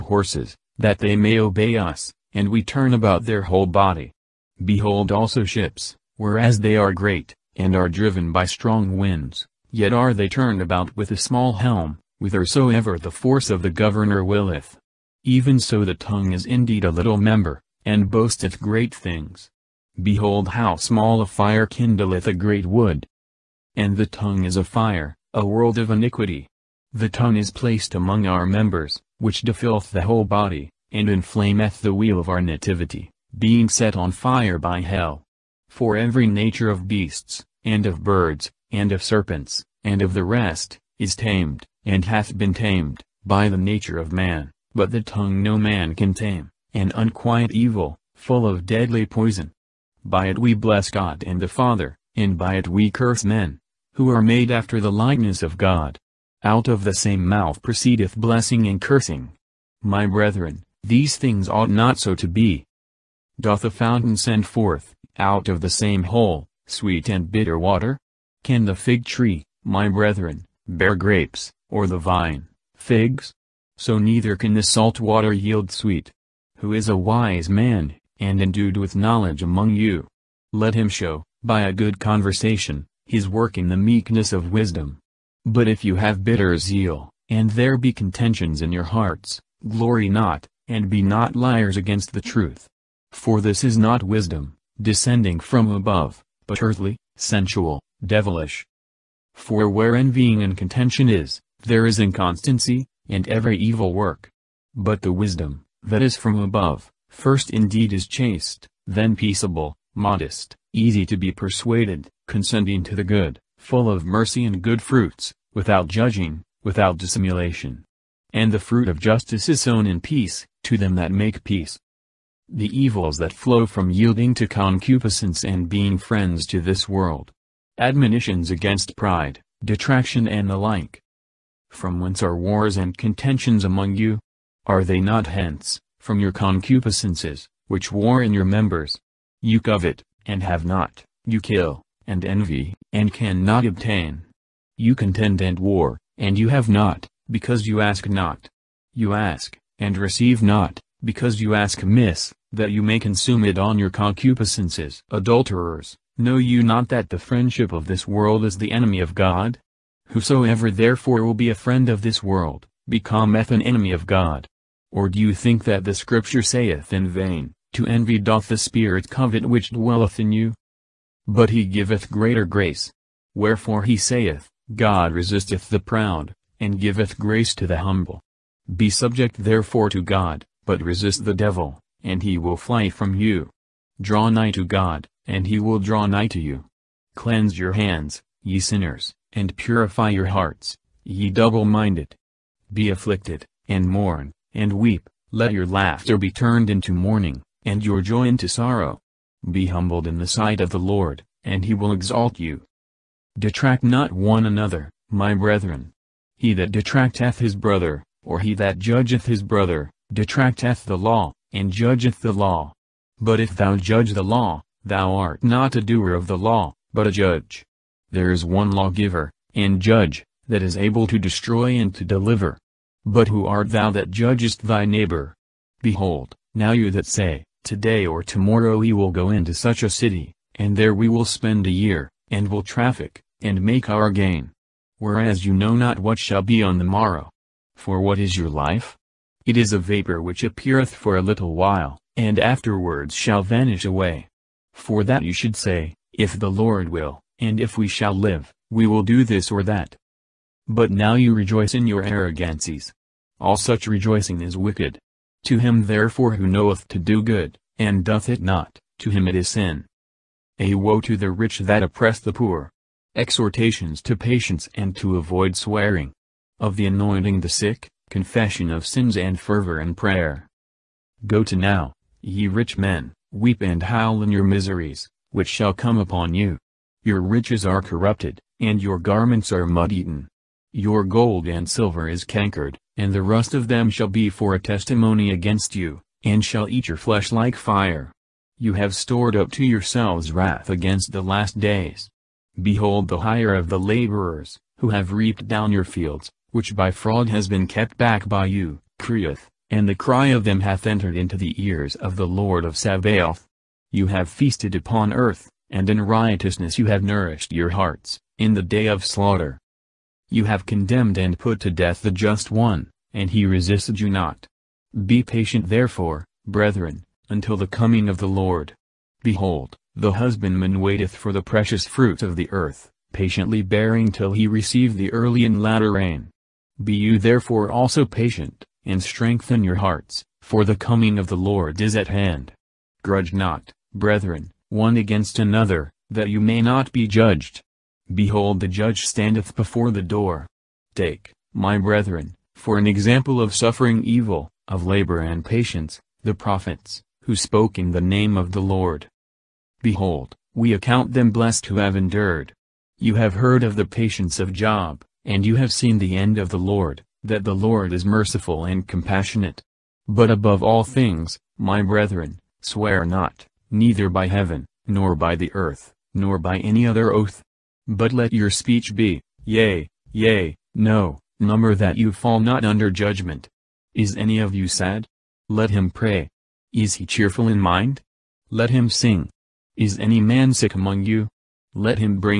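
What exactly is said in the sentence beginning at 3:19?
Be humbled in the sight of the Lord, and he will exalt you.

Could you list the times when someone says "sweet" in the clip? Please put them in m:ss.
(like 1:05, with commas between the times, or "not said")
1:06, 1:15.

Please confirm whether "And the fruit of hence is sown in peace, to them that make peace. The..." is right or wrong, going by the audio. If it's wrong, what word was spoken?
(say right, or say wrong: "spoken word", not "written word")
wrong: "justice", not "hence".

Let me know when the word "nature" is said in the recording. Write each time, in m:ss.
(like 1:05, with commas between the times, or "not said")
0:36, 0:43.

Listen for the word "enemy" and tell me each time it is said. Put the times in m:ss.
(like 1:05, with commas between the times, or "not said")
2:38, 2:43.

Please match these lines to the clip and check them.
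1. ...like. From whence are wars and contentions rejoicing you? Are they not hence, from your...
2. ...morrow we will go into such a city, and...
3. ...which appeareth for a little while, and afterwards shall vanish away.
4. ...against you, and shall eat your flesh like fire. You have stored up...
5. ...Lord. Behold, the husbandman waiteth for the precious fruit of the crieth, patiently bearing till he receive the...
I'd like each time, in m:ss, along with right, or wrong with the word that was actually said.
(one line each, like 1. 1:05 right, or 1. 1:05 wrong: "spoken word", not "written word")
1. 2:10 wrong: "among", not "rejoicing"
2. 3:48 wrong: "tomorrow", not "morrow"
3. 4:00 right
4. 4:45 right
5. 5:18 wrong: "earth", not "crieth".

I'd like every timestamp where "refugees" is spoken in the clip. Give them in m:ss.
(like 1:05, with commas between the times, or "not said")
not said.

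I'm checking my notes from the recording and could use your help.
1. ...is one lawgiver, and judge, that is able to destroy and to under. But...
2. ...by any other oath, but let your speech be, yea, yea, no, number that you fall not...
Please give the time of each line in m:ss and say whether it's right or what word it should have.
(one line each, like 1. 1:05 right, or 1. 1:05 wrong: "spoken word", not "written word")
1. 3:38 wrong: "deliver", not "under"
2. 6:06 right.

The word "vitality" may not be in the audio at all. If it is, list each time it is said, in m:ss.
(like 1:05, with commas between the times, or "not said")
not said.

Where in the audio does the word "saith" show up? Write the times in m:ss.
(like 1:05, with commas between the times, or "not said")
2:46, 2:53.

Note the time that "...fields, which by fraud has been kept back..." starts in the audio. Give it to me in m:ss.
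4:55.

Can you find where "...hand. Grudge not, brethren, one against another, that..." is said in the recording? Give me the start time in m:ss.
5:32.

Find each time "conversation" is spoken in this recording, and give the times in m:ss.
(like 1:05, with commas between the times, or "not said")
1:21.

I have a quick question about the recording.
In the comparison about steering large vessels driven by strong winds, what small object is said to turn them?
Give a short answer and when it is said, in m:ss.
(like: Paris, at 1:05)
A small helm, at 0:11.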